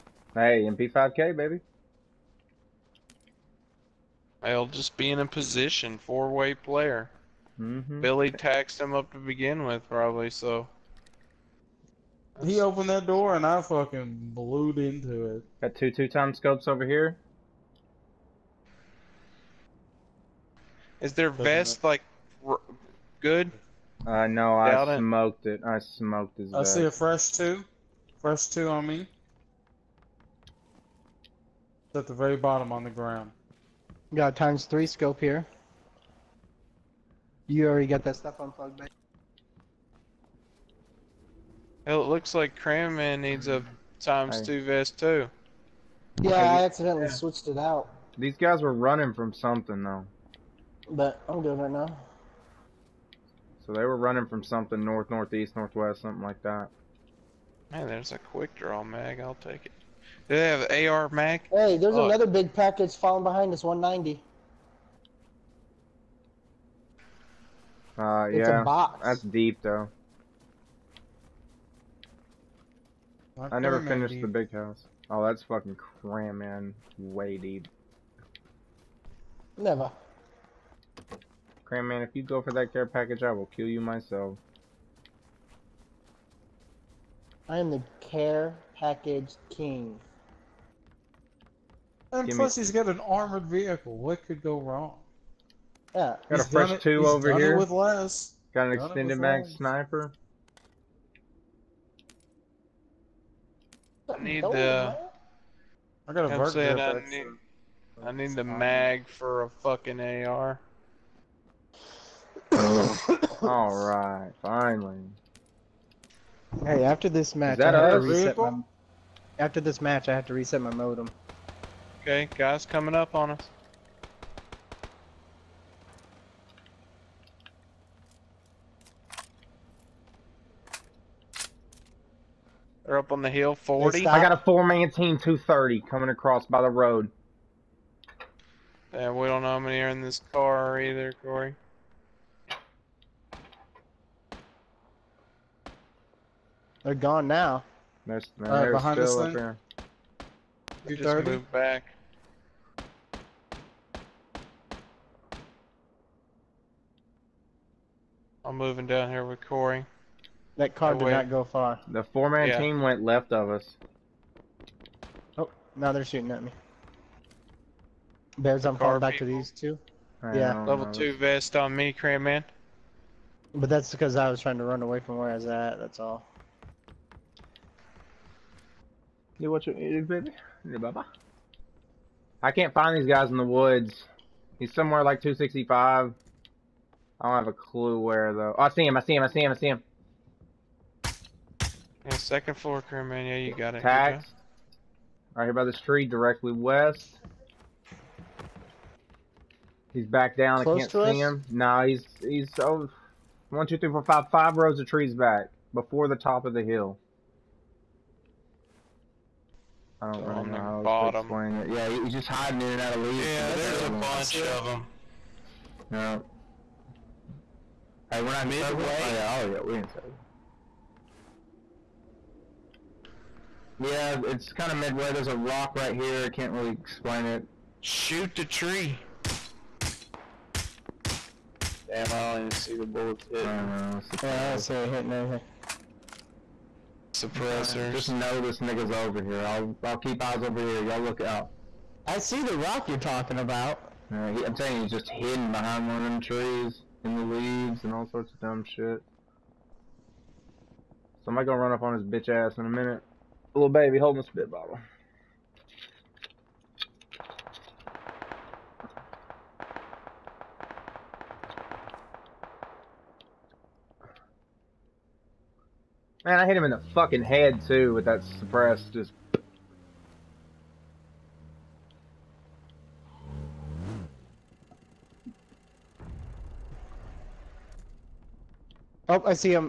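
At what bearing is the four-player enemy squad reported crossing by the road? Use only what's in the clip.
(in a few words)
230.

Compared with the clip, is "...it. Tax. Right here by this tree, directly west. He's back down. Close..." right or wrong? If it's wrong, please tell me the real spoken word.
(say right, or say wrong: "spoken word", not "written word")
right.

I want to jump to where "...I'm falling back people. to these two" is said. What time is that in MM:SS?
02:48.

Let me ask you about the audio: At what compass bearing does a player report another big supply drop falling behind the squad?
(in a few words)
190.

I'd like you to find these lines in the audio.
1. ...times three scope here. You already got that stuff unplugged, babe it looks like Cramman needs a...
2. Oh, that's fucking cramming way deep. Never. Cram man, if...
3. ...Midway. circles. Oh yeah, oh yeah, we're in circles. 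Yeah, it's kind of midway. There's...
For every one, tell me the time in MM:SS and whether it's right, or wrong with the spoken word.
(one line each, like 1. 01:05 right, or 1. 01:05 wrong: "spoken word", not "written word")
1. 00:34 right
2. 01:15 right
3. 03:38 right.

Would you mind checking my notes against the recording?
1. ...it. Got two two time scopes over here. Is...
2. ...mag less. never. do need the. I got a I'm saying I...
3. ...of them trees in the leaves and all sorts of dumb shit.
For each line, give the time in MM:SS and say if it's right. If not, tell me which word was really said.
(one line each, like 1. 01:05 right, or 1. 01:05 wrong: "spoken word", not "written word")
1. 00:15 right
2. 01:39 wrong: "sniper", not "never"
3. 04:05 right.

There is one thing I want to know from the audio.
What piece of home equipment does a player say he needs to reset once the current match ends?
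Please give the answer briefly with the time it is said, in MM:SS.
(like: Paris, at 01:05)
modem, at 02:00.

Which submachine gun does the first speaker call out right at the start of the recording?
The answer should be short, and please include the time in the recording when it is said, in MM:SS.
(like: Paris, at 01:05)
MP5K, at 00:00.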